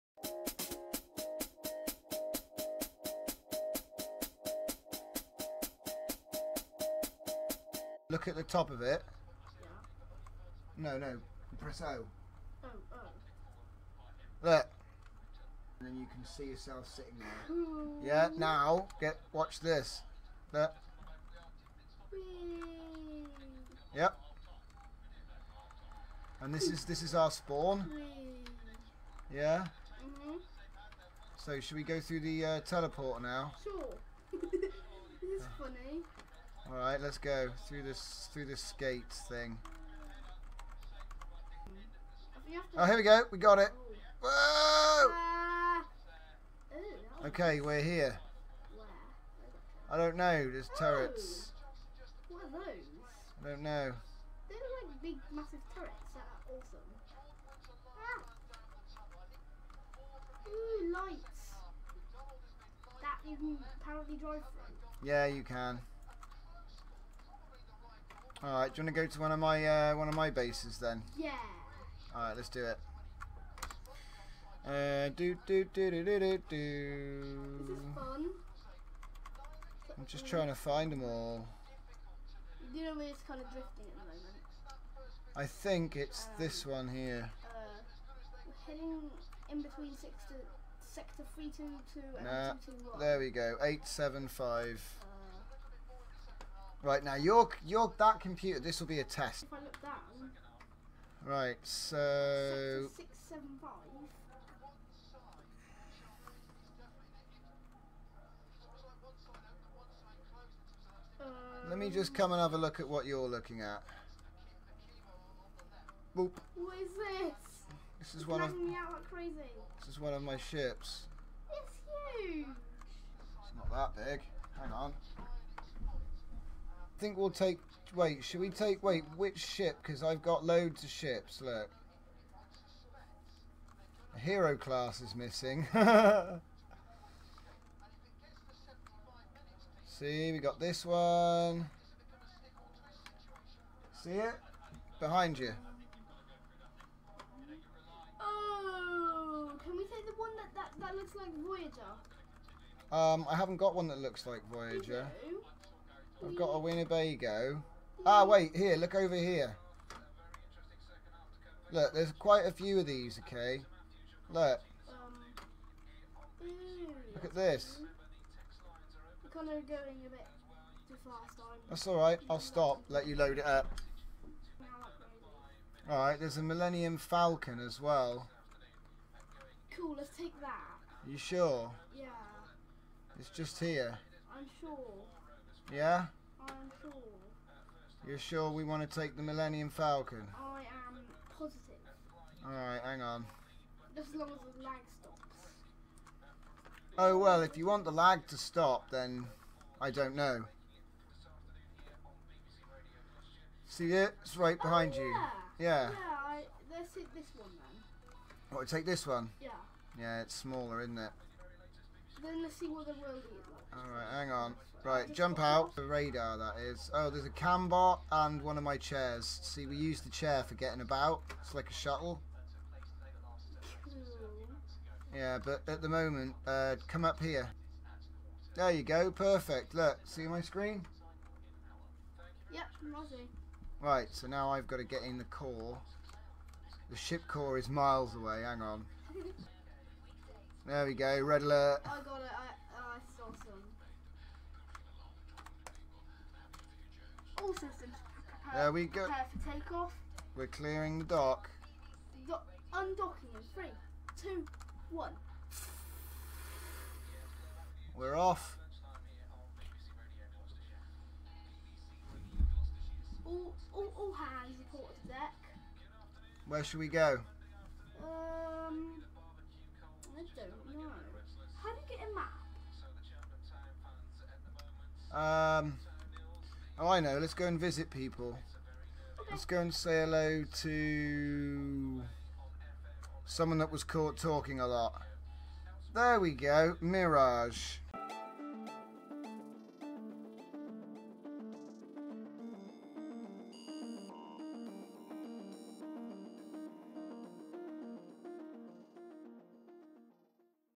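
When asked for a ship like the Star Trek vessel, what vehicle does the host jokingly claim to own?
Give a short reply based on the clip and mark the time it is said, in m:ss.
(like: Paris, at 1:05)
Winnebago, at 2:36.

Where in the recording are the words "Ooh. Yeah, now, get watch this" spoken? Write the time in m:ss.
0:17.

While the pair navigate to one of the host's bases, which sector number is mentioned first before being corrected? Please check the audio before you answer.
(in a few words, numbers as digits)
322.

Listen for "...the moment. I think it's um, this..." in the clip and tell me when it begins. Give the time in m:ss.
1:23.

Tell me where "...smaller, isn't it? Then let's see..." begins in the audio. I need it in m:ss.
3:30.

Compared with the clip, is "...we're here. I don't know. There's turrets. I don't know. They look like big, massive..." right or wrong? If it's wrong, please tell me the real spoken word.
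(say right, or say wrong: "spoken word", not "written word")
right.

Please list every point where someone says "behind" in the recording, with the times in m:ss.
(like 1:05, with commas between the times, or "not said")
2:24, 3:24.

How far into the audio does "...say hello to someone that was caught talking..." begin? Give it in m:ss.
4:39.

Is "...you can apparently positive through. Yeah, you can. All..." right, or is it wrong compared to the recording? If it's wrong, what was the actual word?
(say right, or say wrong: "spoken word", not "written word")
wrong: "drive", not "positive".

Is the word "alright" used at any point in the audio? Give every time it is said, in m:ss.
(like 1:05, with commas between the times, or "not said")
2:51, 2:55, 3:12, 3:33.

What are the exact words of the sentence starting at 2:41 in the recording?
Look, there's quite a few of these, okay?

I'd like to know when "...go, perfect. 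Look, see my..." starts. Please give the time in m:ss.
3:48.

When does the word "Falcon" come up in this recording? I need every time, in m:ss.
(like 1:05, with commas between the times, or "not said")
2:56, 3:09.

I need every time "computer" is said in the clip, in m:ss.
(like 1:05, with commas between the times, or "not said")
1:38.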